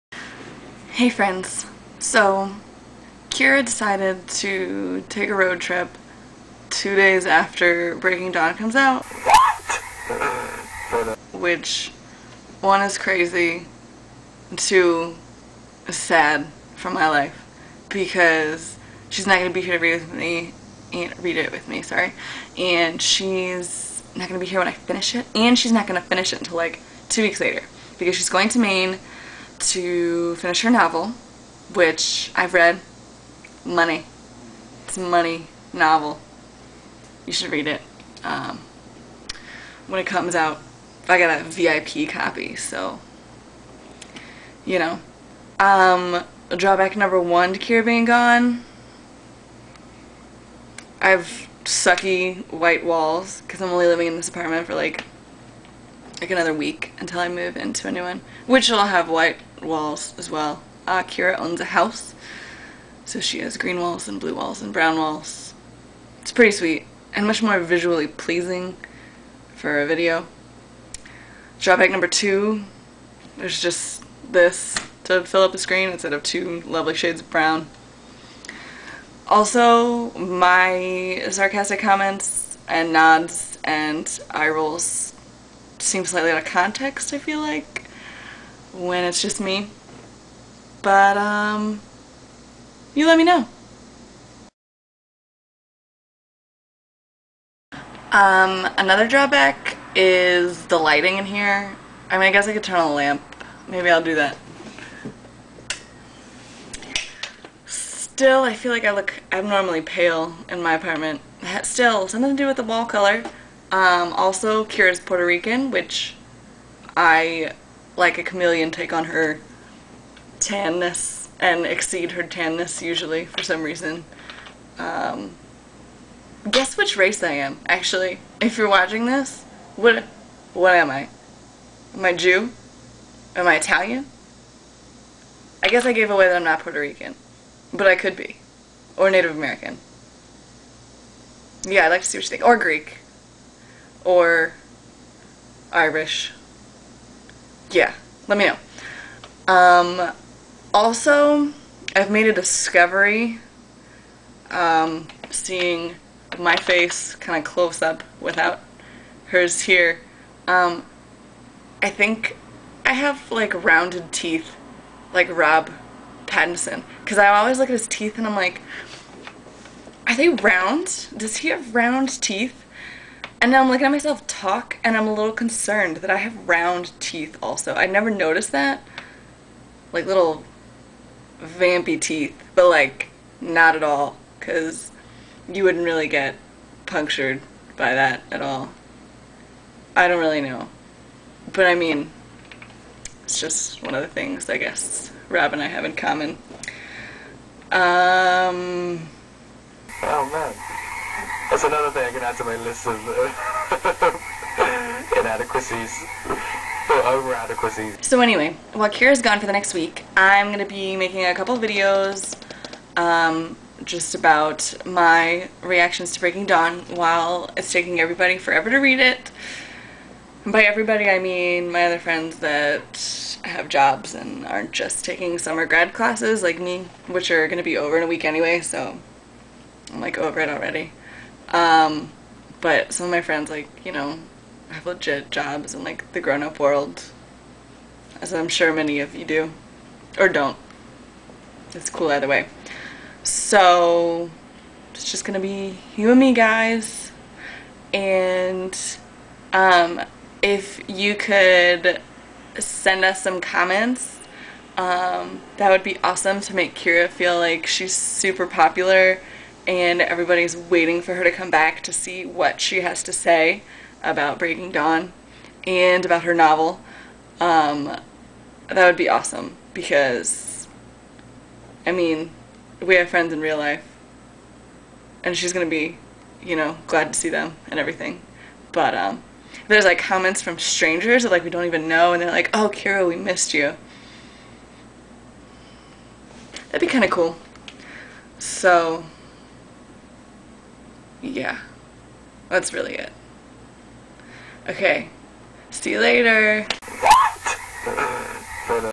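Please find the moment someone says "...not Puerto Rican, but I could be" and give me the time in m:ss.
2:16.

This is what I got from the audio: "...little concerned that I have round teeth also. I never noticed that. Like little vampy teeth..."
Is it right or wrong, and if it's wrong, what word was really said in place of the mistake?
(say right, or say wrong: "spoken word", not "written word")
right.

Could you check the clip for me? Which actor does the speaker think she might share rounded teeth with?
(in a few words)
Rob Pattinson.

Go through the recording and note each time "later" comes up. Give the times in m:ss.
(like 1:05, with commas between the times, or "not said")
0:27, 4:55.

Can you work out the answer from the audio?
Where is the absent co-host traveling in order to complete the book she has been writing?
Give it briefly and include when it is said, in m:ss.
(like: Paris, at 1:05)
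Maine, at 0:28.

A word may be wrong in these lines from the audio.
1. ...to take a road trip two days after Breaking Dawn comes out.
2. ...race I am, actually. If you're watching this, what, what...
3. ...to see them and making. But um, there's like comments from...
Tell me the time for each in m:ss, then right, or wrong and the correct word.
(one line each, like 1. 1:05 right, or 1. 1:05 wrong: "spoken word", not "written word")
1. 0:04 right
2. 2:06 right
3. 4:37 wrong: "everything", not "making".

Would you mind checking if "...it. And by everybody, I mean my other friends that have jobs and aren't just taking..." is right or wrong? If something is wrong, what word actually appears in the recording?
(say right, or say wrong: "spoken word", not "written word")
right.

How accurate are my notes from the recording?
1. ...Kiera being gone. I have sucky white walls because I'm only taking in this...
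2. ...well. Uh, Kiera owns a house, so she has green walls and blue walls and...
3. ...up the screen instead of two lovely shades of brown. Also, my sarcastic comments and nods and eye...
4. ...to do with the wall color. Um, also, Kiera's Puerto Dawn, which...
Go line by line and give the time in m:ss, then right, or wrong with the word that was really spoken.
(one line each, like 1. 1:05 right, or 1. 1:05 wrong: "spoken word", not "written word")
1. 0:47 wrong: "living", not "taking"
2. 1:00 right
3. 1:15 right
4. 1:52 wrong: "Rican", not "Dawn".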